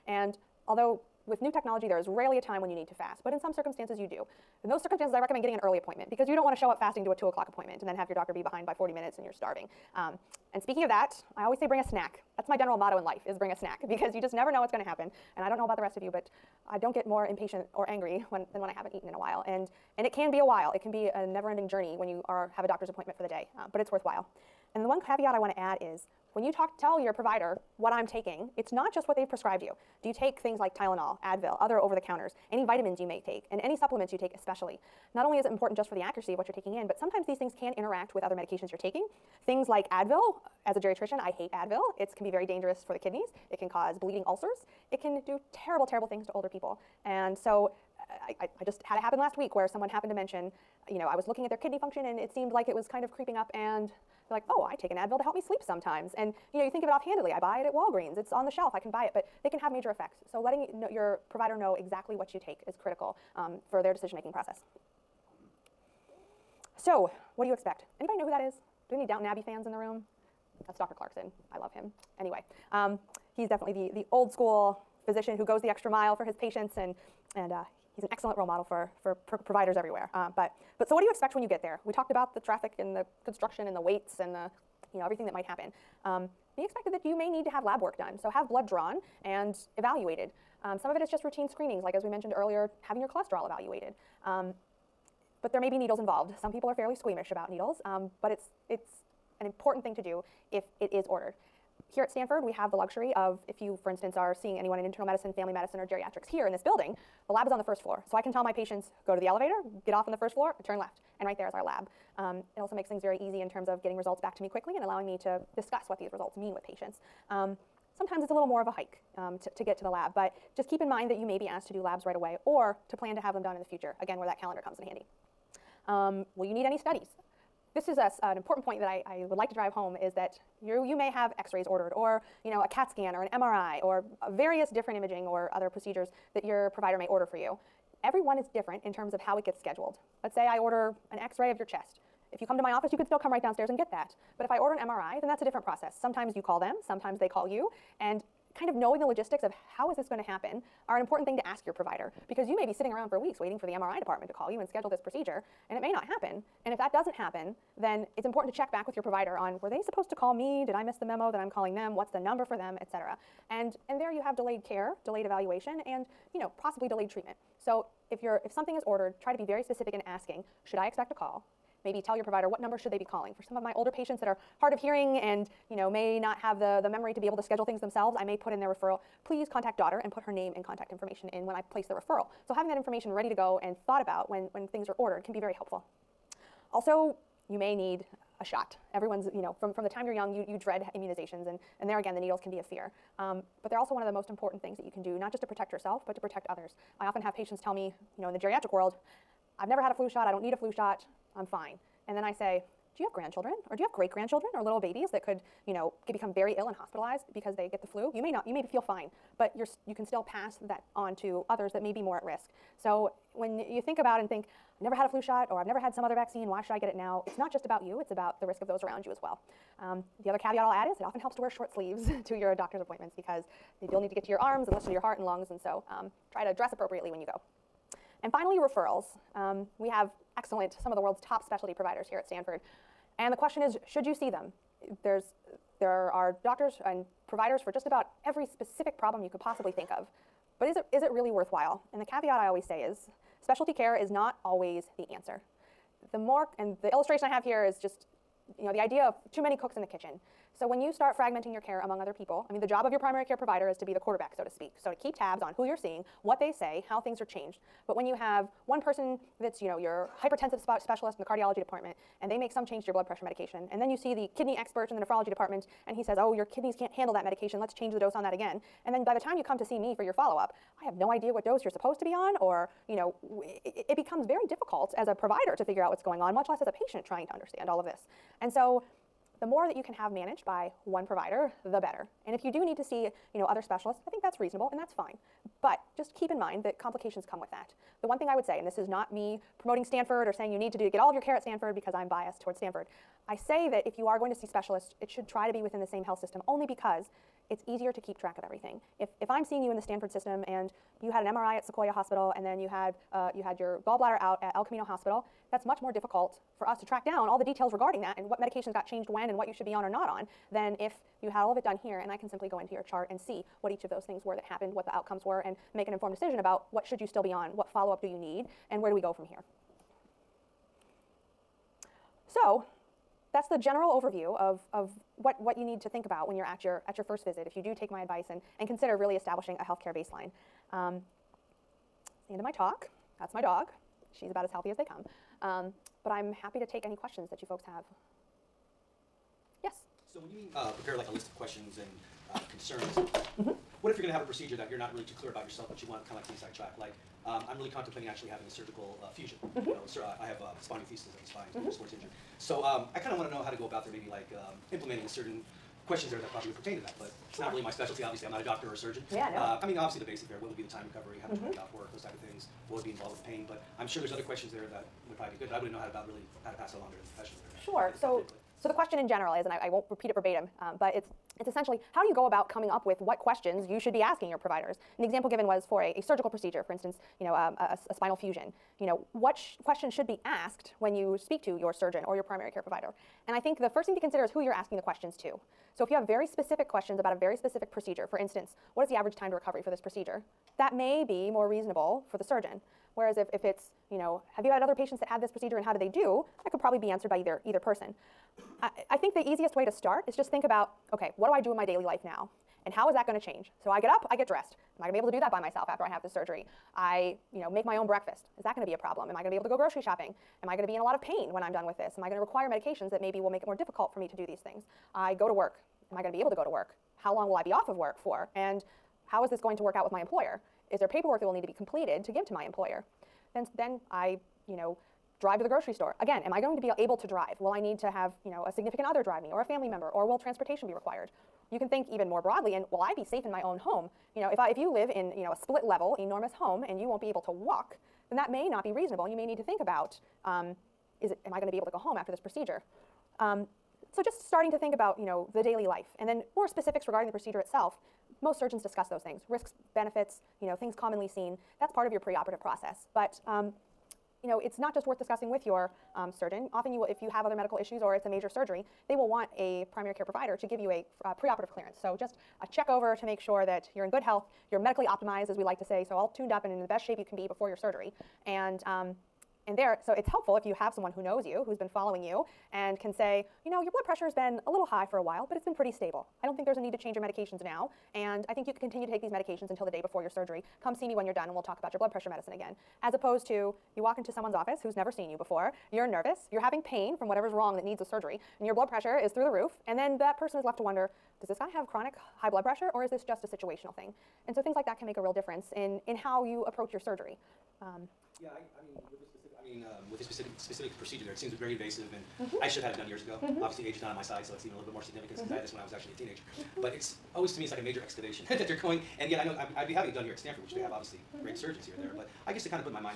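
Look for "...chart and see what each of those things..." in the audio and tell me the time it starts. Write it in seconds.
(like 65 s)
312 s.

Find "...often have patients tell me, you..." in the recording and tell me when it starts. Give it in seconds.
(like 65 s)
197 s.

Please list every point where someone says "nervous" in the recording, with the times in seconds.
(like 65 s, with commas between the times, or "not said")
485 s.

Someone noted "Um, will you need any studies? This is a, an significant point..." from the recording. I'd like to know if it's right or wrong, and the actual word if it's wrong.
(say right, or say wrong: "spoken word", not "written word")
wrong: "important", not "significant".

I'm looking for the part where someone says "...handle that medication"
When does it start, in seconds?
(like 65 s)
266 s.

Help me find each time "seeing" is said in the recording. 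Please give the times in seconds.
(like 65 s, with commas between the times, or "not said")
104 s, 255 s, 299 s.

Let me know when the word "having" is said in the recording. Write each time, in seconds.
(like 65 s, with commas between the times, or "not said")
92 s, 182 s, 348 s, 486 s, 509 s.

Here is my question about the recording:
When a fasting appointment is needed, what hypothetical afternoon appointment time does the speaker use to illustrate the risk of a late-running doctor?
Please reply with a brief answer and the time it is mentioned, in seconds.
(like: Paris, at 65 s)
2 o'clock, at 7 s.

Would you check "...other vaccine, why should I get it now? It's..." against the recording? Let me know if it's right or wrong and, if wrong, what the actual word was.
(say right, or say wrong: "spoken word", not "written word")
right.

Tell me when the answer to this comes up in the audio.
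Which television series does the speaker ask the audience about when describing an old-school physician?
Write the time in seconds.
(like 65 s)
69 s.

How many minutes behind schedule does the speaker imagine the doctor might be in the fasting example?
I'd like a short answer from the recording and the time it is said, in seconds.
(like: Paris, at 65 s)
40, at 8 s.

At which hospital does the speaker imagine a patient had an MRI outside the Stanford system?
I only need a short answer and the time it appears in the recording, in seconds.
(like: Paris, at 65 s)
Sequoia Hospital, at 301 s.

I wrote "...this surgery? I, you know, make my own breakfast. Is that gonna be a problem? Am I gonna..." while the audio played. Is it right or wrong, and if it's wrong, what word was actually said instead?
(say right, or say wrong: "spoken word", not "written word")
right.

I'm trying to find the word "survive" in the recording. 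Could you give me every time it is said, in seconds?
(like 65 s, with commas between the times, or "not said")
not said.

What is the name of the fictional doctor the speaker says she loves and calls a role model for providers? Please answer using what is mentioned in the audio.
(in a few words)
Dr. Clarkson.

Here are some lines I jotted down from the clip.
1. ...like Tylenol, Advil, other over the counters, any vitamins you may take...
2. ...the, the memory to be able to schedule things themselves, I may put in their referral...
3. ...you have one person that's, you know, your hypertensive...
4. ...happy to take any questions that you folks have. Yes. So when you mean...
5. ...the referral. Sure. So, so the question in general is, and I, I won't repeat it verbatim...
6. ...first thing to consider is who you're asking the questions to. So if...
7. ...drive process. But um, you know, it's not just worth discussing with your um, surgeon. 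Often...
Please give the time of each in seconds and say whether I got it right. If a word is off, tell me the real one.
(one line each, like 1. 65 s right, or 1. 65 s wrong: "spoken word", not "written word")
1. 30 s right
2. 176 s right
3. 258 s right
4. 336 s right
5. 366 s wrong: "professional", not "referral"
6. 383 s right
7. 451 s wrong: "preoperative", not "drive".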